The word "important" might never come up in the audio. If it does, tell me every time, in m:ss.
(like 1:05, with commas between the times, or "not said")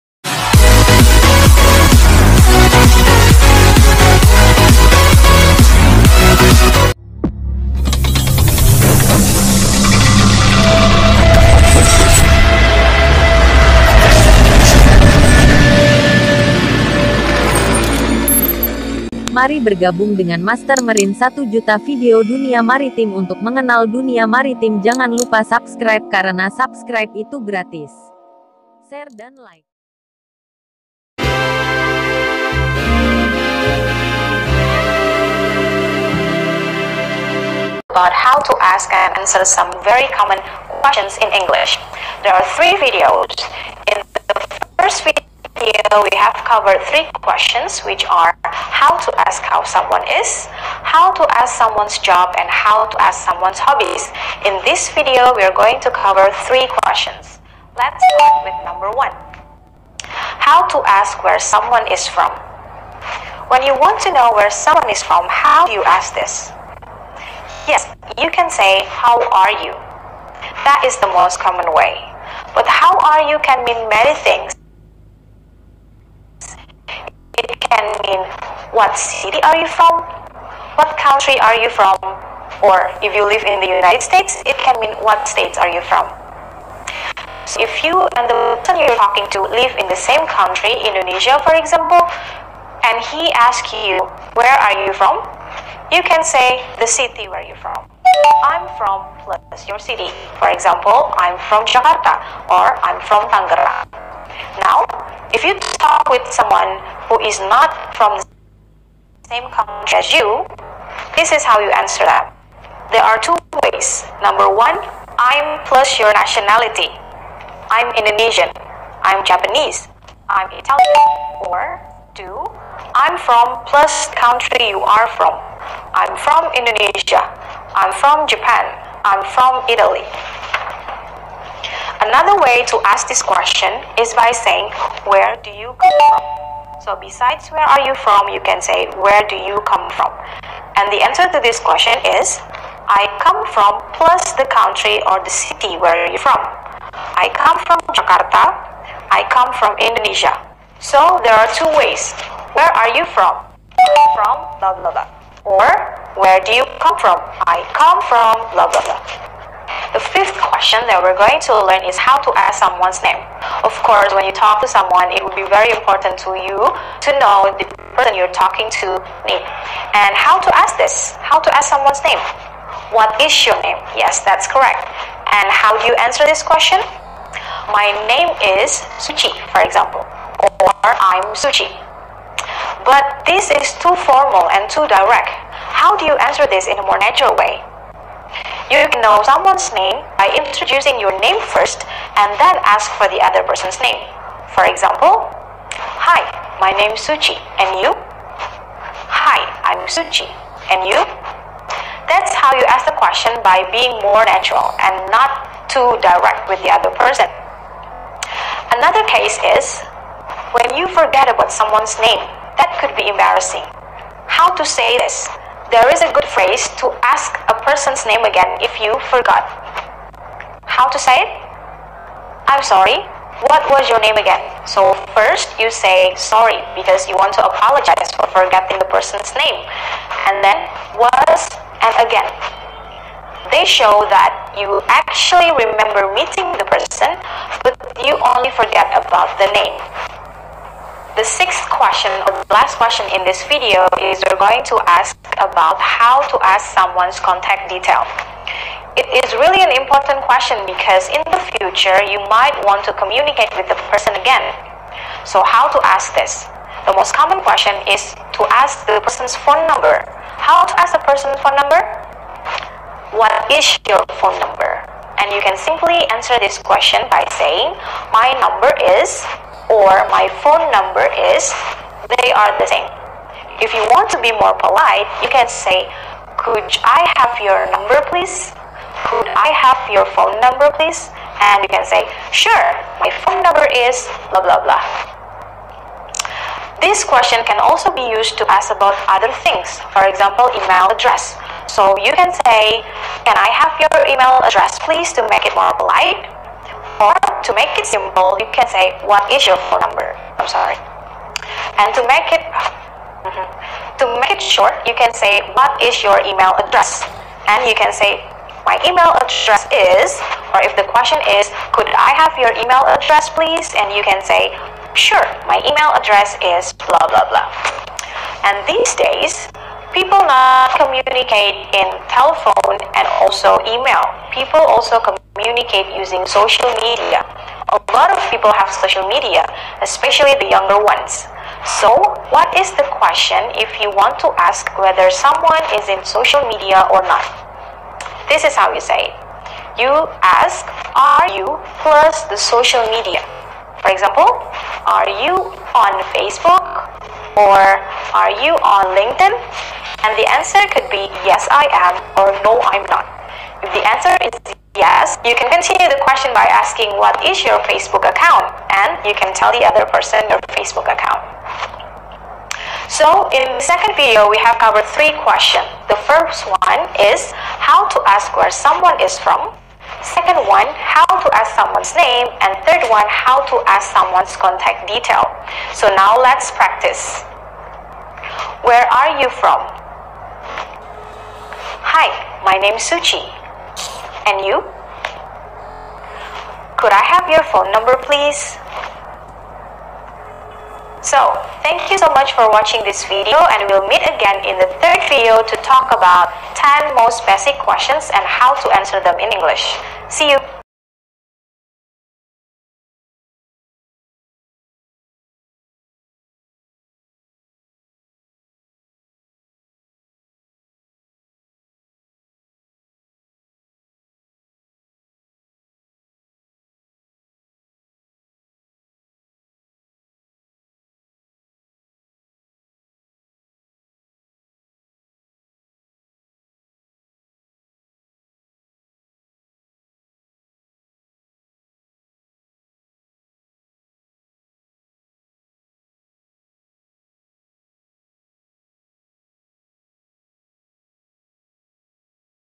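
2:45, 4:09.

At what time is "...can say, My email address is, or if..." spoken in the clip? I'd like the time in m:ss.
5:07.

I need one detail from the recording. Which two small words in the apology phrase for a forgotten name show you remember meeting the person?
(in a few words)
was and again.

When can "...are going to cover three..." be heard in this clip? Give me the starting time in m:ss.
0:55.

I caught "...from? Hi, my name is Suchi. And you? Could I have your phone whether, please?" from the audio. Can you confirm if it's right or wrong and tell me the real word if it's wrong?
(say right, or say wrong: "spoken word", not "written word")
wrong: "number", not "whether".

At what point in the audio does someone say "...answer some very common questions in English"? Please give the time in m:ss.
0:39.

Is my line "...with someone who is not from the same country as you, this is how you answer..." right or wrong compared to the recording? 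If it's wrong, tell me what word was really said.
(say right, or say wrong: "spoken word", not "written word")
right.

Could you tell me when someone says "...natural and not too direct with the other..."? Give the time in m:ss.
3:24.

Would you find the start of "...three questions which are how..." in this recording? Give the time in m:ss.
0:46.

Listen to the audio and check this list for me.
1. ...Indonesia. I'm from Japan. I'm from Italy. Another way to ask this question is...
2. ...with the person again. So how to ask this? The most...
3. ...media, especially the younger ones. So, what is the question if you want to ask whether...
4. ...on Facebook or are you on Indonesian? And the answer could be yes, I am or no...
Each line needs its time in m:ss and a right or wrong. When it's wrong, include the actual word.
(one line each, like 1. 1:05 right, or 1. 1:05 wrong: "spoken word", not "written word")
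1. 2:06 right
2. 4:13 right
3. 5:29 right
4. 5:45 wrong: "LinkedIn", not "Indonesian".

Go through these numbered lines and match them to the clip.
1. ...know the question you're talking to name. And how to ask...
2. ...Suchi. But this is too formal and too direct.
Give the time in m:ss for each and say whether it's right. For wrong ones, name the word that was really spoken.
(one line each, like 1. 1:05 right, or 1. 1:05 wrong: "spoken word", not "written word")
1. 2:47 wrong: "person", not "question"
2. 3:01 right.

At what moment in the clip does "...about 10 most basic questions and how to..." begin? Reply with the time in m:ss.
6:35.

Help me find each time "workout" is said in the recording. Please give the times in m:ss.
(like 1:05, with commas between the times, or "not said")
not said.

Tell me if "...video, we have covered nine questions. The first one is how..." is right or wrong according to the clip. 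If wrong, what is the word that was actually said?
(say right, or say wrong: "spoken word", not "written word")
wrong: "three", not "nine".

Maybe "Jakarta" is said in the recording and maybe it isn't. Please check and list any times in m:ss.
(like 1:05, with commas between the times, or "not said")
1:41, 2:27.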